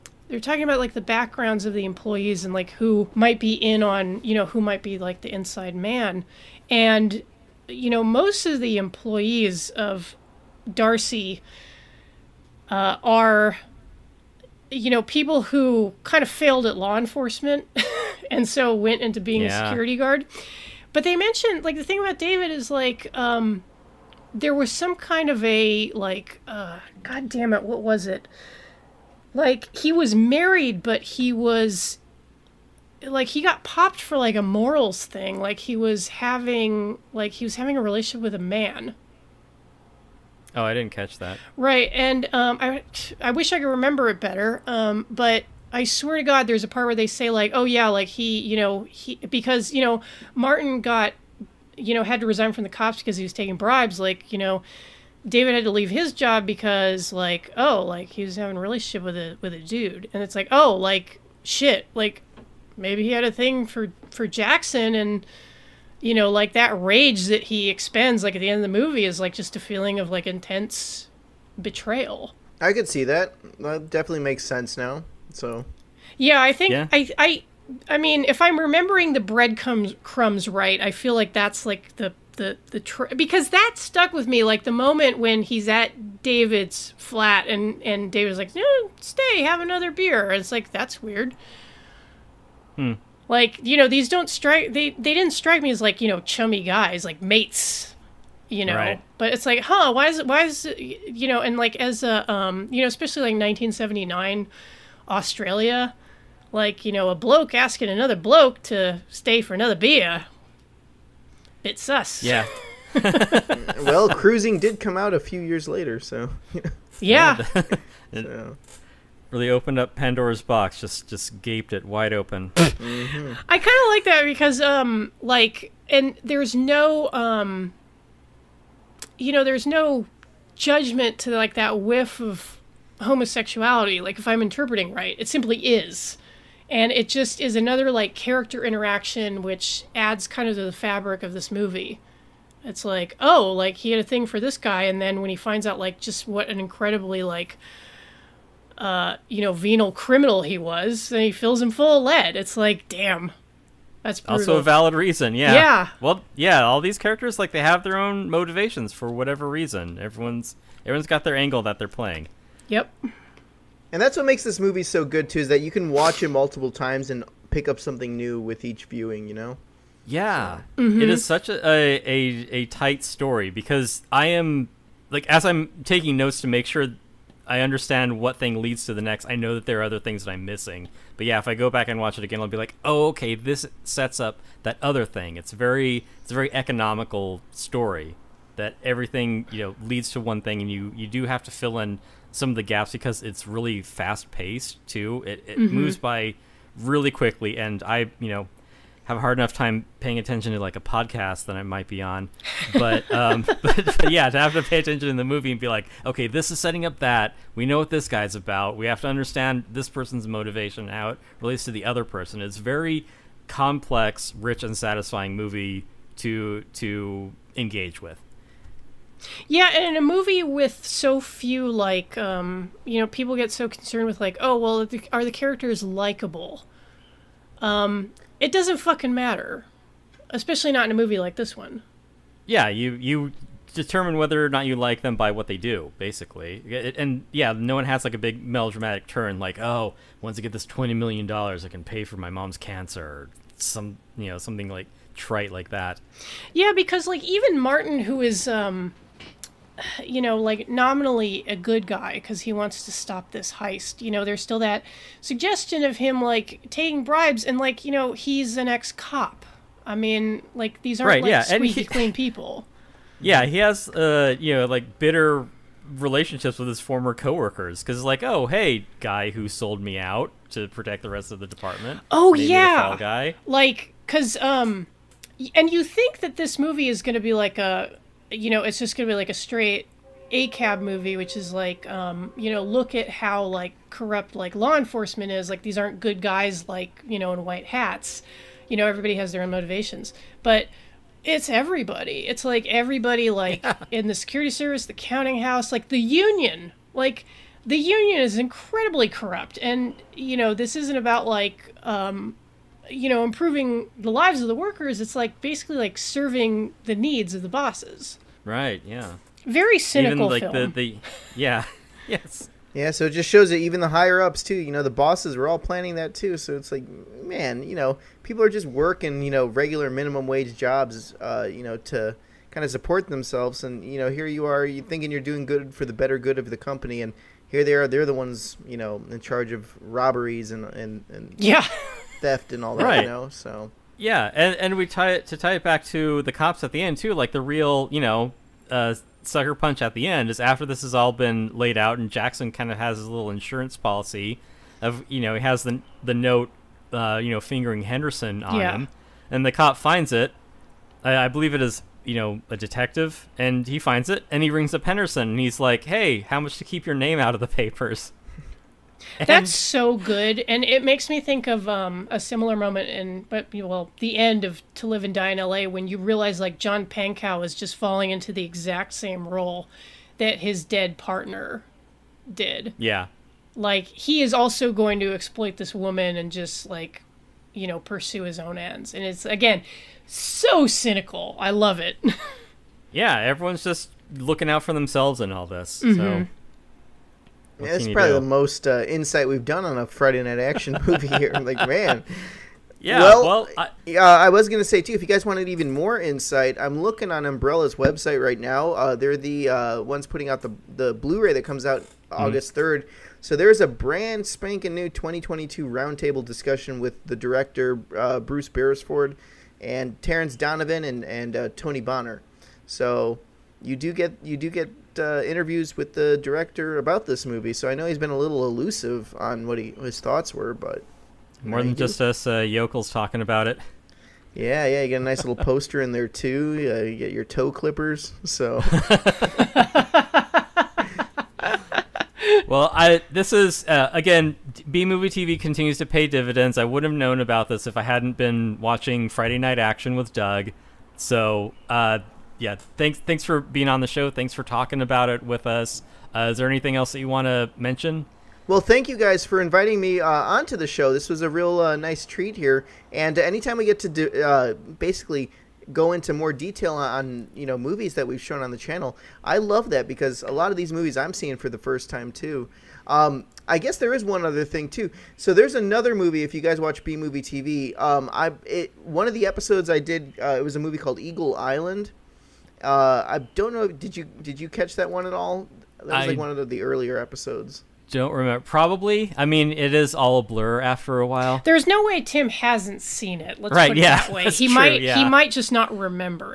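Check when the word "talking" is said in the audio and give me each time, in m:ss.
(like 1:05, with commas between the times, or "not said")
0:00, 7:02, 7:24.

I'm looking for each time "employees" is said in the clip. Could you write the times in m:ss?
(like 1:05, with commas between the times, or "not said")
0:01, 0:08.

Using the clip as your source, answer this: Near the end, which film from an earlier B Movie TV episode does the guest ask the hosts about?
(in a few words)
Eagle Island.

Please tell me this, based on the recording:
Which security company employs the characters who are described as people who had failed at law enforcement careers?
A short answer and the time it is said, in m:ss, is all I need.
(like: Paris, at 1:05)
Darcy, at 0:10.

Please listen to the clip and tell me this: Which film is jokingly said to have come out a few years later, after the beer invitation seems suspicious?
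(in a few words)
Cruising.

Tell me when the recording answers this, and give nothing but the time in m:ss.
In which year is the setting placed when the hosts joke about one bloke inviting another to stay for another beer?
1:43.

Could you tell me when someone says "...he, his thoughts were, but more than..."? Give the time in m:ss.
6:59.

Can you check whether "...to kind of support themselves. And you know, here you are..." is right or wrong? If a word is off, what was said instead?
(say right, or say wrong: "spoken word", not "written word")
right.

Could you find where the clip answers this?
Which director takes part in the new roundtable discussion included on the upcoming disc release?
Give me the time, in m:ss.
6:48.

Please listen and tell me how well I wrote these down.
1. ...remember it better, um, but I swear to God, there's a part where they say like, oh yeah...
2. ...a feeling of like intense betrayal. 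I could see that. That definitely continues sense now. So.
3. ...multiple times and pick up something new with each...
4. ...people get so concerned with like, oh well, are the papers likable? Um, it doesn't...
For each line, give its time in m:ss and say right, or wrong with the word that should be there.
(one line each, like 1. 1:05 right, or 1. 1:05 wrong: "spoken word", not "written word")
1. 0:43 right
2. 1:09 wrong: "makes", not "continues"
3. 2:46 right
4. 3:43 wrong: "characters", not "papers".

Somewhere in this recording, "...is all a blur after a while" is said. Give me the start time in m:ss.
7:59.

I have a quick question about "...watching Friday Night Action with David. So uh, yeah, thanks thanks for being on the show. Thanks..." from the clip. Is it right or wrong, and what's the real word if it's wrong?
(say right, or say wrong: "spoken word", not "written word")
wrong: "Doug", not "David".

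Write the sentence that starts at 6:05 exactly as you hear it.
when you realize like John Pankow is just falling into the exact same role that his dead partner did.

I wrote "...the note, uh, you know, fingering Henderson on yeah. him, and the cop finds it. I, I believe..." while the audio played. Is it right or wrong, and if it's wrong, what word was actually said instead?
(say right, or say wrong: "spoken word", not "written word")
right.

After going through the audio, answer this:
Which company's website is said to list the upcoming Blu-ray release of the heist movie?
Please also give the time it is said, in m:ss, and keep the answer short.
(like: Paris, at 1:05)
Umbrella, at 6:37.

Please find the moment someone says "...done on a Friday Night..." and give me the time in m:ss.
6:29.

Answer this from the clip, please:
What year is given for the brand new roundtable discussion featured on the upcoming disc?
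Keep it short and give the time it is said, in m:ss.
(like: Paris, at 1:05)
2022, at 6:44.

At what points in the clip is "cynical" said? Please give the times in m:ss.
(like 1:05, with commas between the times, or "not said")
5:09, 6:20.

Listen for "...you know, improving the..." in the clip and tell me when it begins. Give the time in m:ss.
5:02.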